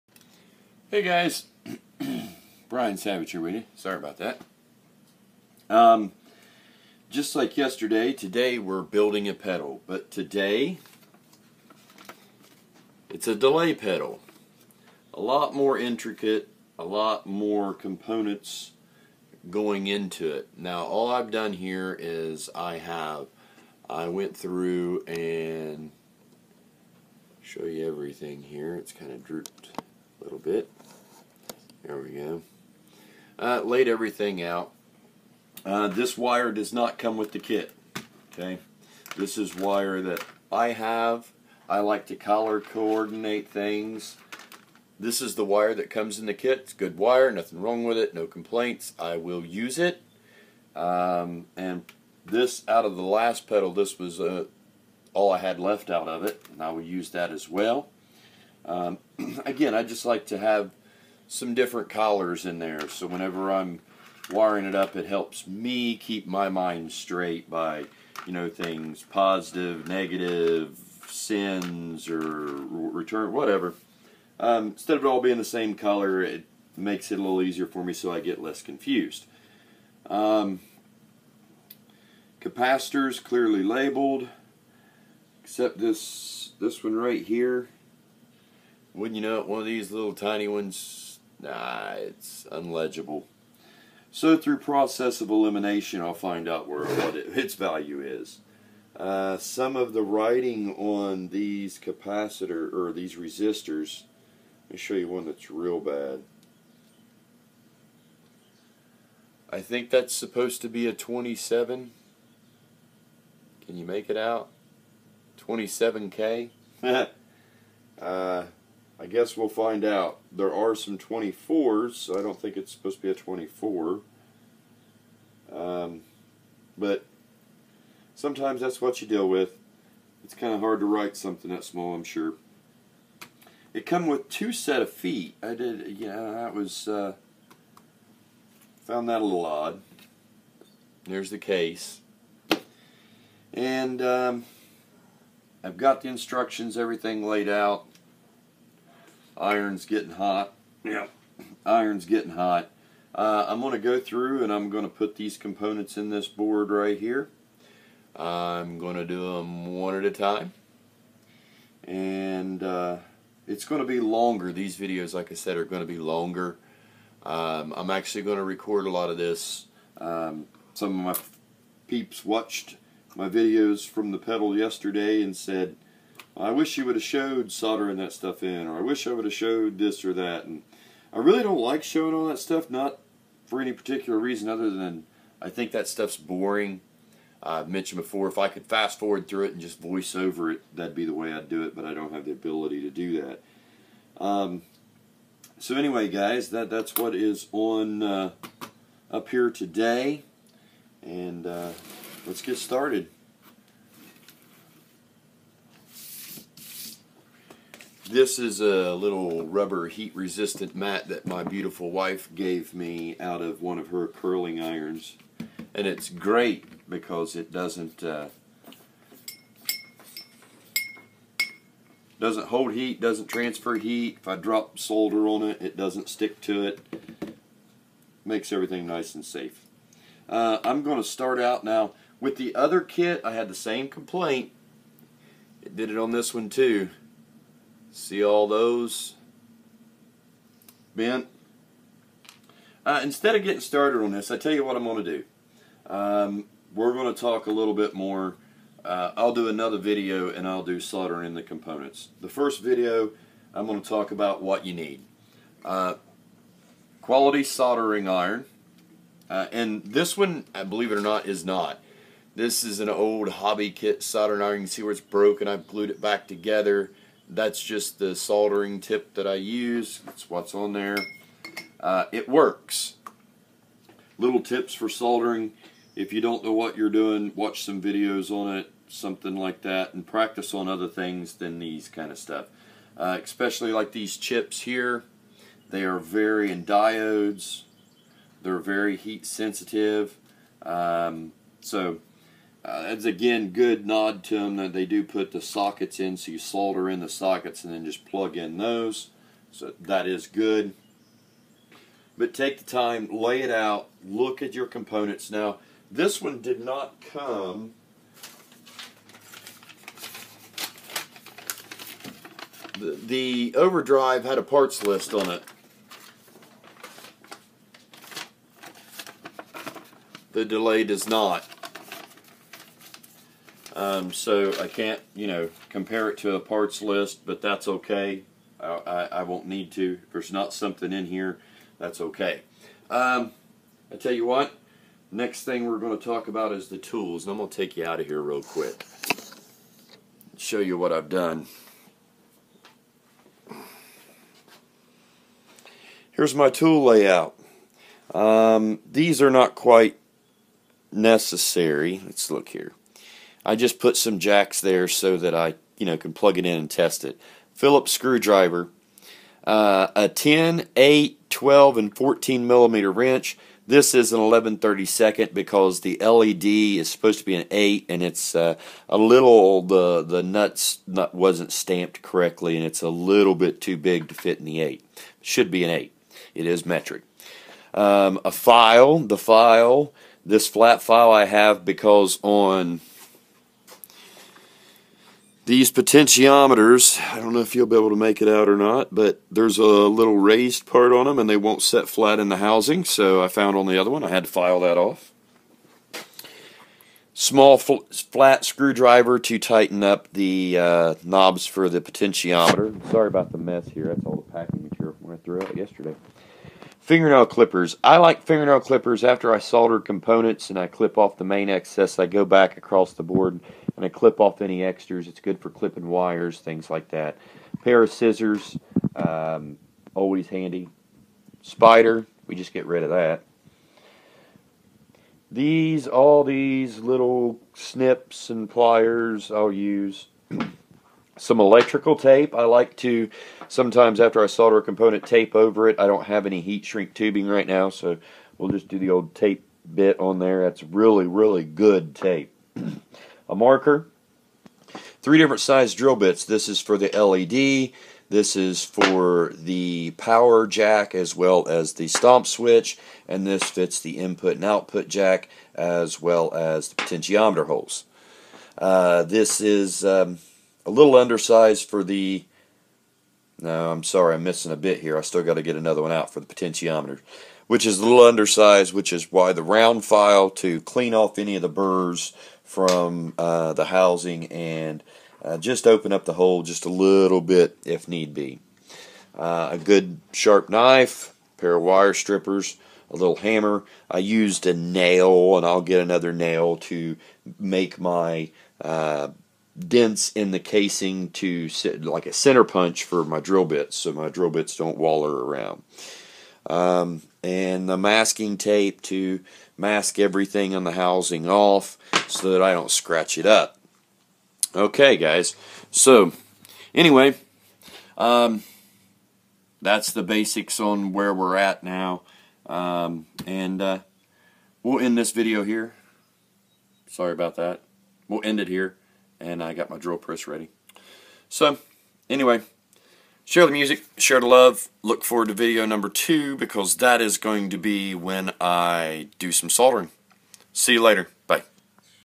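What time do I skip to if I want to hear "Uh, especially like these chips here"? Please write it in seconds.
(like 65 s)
282 s.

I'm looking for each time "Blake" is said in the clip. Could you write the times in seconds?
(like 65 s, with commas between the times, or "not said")
not said.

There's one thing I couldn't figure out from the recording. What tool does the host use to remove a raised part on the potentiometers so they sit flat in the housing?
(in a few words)
flat file.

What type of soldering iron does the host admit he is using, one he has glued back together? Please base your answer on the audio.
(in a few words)
old hobby kit soldering iron.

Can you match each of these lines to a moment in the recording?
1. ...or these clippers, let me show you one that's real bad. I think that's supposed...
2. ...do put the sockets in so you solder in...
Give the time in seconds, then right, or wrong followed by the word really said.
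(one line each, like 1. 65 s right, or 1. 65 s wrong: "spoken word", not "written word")
1. 102 s wrong: "resistors", not "clippers"
2. 294 s right.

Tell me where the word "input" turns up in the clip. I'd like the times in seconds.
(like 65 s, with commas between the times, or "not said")
453 s.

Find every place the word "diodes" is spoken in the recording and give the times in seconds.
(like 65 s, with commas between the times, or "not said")
286 s.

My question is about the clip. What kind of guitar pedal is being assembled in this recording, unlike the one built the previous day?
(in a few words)
delay pedal.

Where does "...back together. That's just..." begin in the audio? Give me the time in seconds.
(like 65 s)
265 s.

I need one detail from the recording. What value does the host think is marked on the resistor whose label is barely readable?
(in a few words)
27K.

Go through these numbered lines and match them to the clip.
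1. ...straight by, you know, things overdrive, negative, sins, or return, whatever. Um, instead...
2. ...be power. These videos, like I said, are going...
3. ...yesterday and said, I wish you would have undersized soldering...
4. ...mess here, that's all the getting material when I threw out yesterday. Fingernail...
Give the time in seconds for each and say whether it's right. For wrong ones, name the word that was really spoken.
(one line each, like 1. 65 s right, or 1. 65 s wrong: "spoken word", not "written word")
1. 66 s wrong: "positive", not "overdrive"
2. 163 s wrong: "longer", not "power"
3. 174 s wrong: "showed", not "undersized"
4. 403 s wrong: "packing", not "getting".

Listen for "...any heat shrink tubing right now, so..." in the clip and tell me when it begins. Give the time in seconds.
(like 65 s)
436 s.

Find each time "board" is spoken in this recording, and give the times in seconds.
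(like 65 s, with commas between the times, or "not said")
156 s, 413 s.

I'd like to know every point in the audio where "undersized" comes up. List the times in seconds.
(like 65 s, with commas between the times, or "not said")
460 s, 468 s.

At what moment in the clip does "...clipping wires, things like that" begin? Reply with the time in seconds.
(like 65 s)
415 s.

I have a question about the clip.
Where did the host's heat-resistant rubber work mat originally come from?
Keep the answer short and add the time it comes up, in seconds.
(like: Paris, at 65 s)
curling irons, at 214 s.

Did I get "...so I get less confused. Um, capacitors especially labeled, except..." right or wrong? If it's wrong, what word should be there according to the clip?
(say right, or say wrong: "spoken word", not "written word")
wrong: "clearly", not "especially".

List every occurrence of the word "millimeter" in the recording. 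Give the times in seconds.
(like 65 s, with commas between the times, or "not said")
362 s.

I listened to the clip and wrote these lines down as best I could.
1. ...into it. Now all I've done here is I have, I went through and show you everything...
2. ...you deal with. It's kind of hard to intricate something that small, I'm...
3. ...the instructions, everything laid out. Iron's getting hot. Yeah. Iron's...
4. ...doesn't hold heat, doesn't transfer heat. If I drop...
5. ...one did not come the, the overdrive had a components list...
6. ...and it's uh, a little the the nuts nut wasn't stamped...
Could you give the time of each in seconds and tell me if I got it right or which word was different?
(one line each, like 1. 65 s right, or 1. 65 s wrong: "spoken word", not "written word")
1. 19 s right
2. 129 s wrong: "write", not "intricate"
3. 146 s right
4. 222 s right
5. 306 s wrong: "parts", not "components"
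6. 367 s right.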